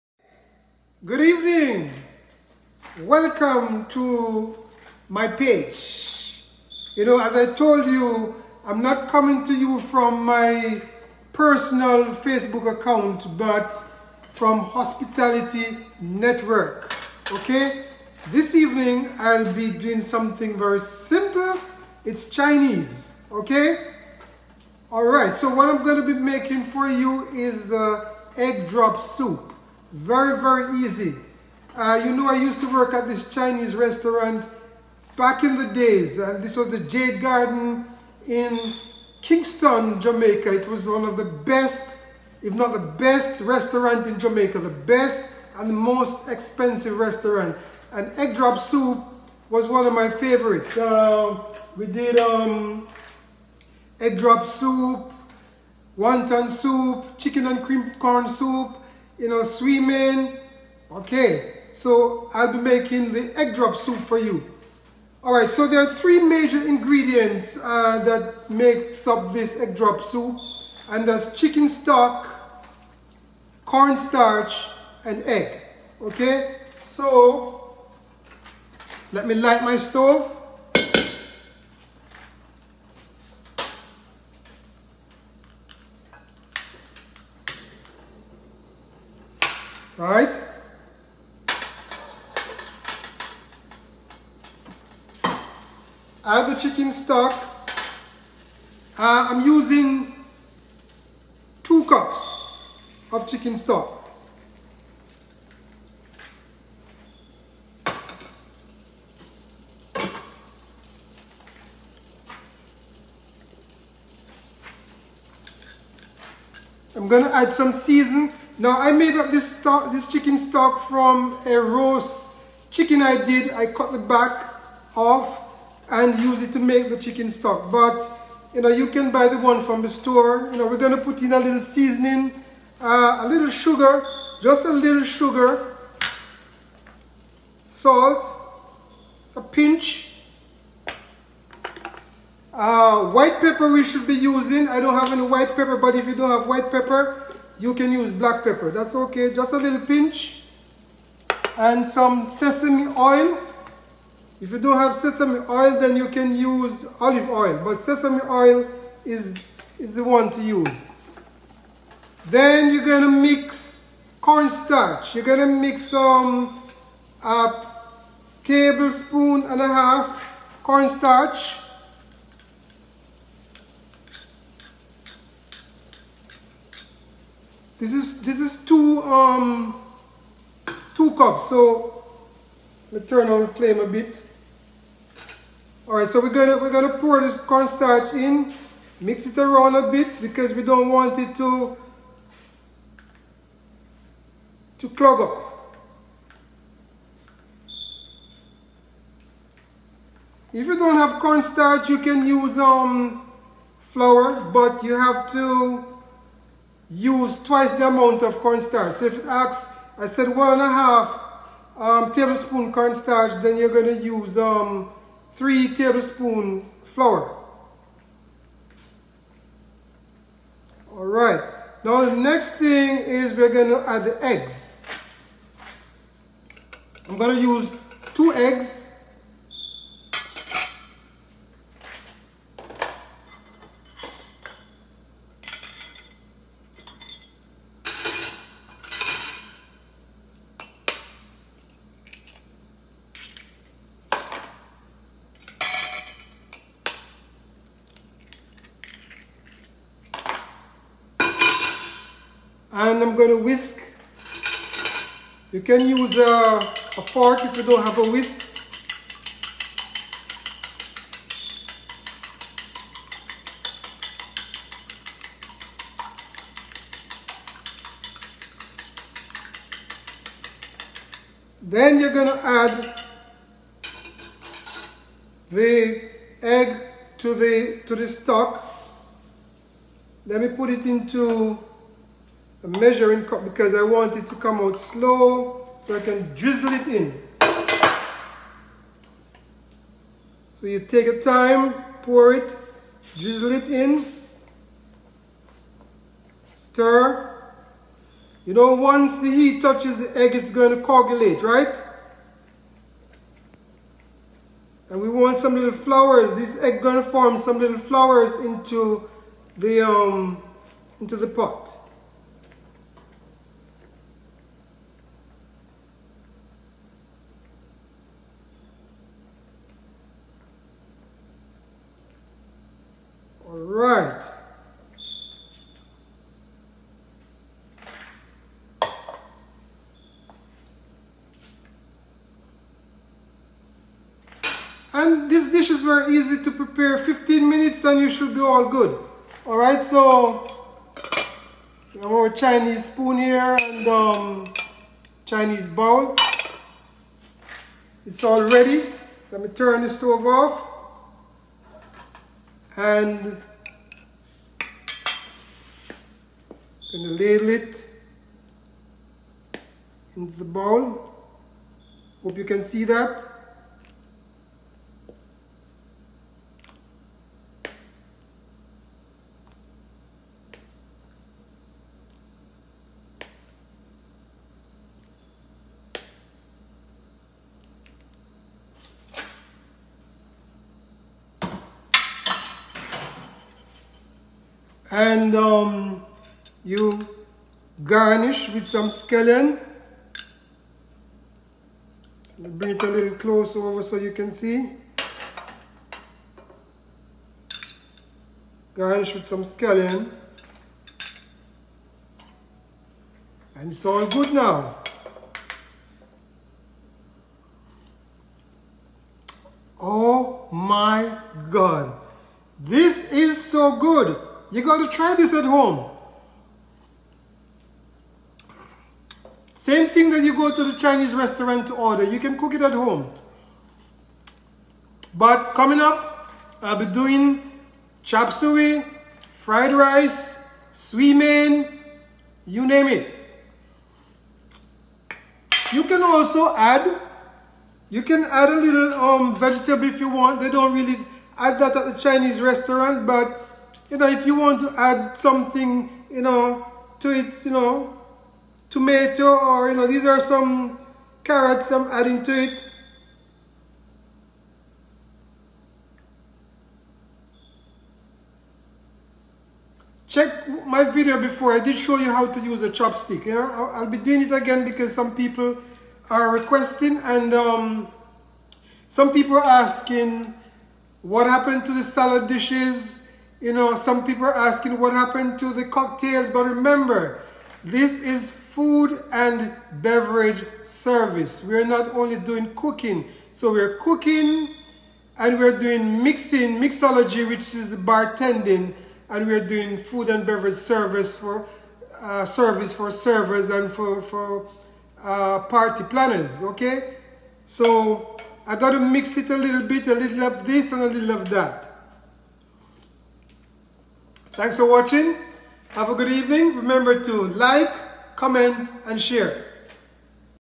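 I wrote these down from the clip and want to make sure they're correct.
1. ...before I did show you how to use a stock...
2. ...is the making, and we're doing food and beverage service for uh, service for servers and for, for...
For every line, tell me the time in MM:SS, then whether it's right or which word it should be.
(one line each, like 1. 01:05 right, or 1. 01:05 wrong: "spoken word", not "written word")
1. 07:41 wrong: "chopstick", not "stock"
2. 08:07 wrong: "bartending", not "making".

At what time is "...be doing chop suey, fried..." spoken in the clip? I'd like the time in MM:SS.
07:06.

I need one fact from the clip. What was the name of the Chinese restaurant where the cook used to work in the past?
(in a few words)
Jade Garden.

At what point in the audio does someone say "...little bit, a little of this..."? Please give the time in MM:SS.
08:19.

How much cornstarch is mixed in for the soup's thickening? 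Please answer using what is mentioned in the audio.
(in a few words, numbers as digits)
1.5 tablespoons.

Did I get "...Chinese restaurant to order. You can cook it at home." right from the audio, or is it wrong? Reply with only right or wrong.
right.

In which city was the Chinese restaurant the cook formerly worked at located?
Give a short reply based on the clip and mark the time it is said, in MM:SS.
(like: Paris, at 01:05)
Kingston, at 00:39.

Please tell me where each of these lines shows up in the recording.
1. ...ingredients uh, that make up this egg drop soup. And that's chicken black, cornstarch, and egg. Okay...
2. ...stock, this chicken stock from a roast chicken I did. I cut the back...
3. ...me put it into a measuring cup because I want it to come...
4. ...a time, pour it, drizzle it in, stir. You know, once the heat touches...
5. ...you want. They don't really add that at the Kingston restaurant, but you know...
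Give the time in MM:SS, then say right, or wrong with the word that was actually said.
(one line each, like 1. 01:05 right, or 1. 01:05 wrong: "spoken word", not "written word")
1. 01:06 wrong: "stock", not "black"
2. 01:59 right
3. 04:40 right
4. 04:51 right
5. 07:19 wrong: "Chinese", not "Kingston".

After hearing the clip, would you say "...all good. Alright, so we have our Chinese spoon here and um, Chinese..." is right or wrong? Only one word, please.
right.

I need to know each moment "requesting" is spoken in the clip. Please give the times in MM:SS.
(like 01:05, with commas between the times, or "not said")
07:46.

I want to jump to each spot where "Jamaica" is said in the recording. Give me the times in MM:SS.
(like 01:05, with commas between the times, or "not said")
00:39, 00:44.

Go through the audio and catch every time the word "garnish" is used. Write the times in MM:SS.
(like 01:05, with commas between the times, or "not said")
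06:27, 06:38.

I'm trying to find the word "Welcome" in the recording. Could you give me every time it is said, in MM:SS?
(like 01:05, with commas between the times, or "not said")
00:03.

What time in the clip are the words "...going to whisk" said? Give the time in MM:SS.
04:13.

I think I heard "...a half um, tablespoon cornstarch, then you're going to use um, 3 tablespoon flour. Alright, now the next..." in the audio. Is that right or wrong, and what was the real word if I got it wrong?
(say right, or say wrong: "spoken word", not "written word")
right.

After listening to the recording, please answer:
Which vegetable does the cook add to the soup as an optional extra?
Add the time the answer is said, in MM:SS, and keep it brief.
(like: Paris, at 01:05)
Carrots, at 07:31.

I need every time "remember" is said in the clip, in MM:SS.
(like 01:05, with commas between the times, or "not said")
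07:56, 08:26.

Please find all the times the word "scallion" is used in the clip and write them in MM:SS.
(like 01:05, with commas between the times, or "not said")
06:28, 06:39.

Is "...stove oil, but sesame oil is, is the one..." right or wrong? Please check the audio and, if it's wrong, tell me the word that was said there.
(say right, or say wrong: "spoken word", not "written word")
wrong: "olive", not "stove".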